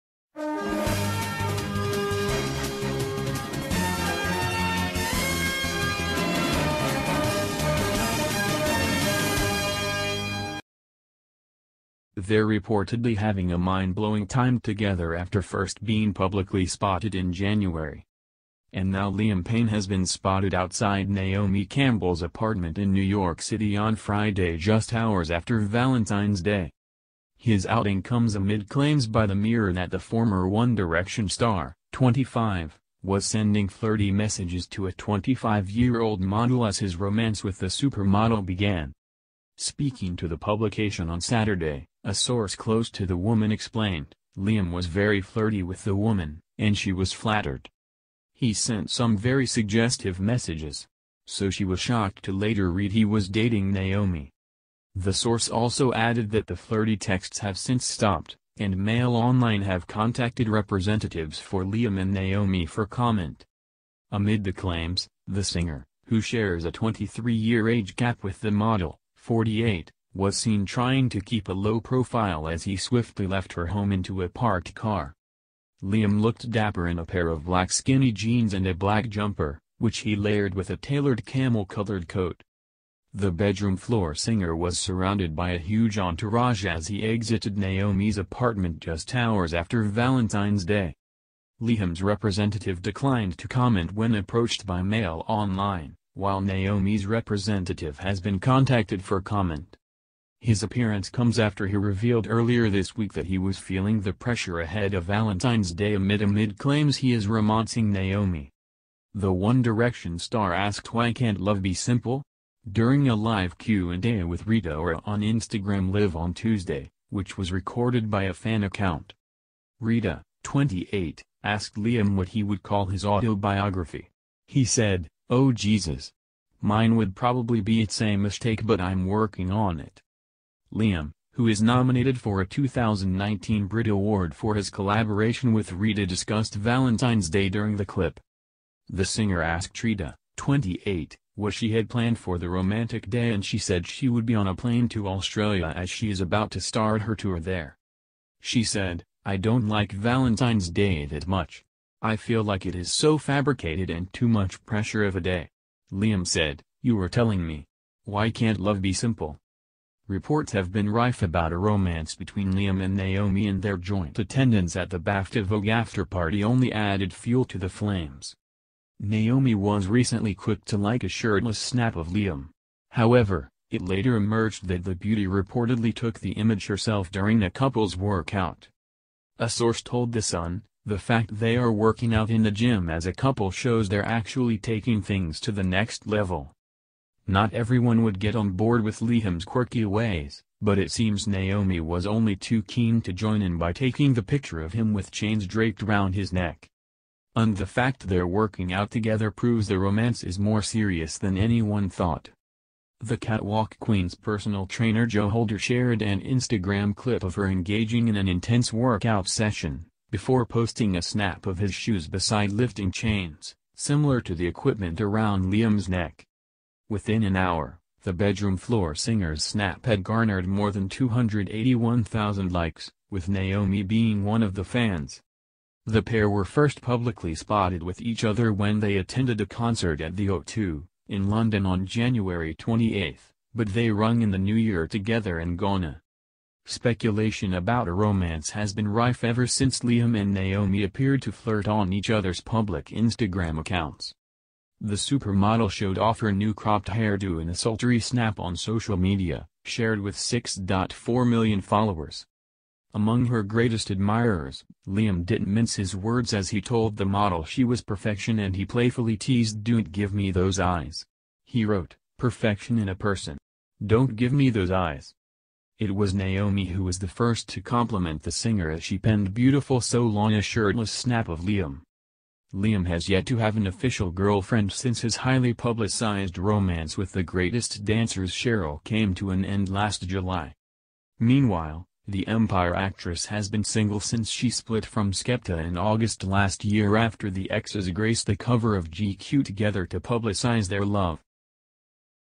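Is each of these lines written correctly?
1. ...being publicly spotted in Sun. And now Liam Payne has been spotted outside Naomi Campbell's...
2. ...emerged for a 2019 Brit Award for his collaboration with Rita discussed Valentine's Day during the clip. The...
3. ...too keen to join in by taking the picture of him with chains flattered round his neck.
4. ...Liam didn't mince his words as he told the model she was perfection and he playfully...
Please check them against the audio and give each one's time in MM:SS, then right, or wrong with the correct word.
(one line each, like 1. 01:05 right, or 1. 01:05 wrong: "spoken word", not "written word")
1. 00:15 wrong: "January", not "Sun"
2. 02:11 wrong: "nominated", not "emerged"
3. 03:12 wrong: "draped", not "flattered"
4. 04:14 right.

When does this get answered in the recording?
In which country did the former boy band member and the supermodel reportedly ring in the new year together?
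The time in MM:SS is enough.
03:55.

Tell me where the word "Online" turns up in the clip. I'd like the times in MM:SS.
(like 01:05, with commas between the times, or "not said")
00:59, 01:35.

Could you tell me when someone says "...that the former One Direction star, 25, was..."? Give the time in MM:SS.
00:29.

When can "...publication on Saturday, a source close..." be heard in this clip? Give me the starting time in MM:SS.
00:40.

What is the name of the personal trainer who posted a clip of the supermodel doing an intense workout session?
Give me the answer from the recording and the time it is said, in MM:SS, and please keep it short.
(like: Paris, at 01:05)
Joe Holder, at 03:25.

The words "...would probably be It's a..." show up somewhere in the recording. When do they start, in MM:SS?
02:06.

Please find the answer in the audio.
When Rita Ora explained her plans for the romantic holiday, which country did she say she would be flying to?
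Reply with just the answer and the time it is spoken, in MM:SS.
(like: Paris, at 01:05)
Australia, at 02:25.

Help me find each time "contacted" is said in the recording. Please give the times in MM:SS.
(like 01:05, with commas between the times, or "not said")
00:59, 01:38.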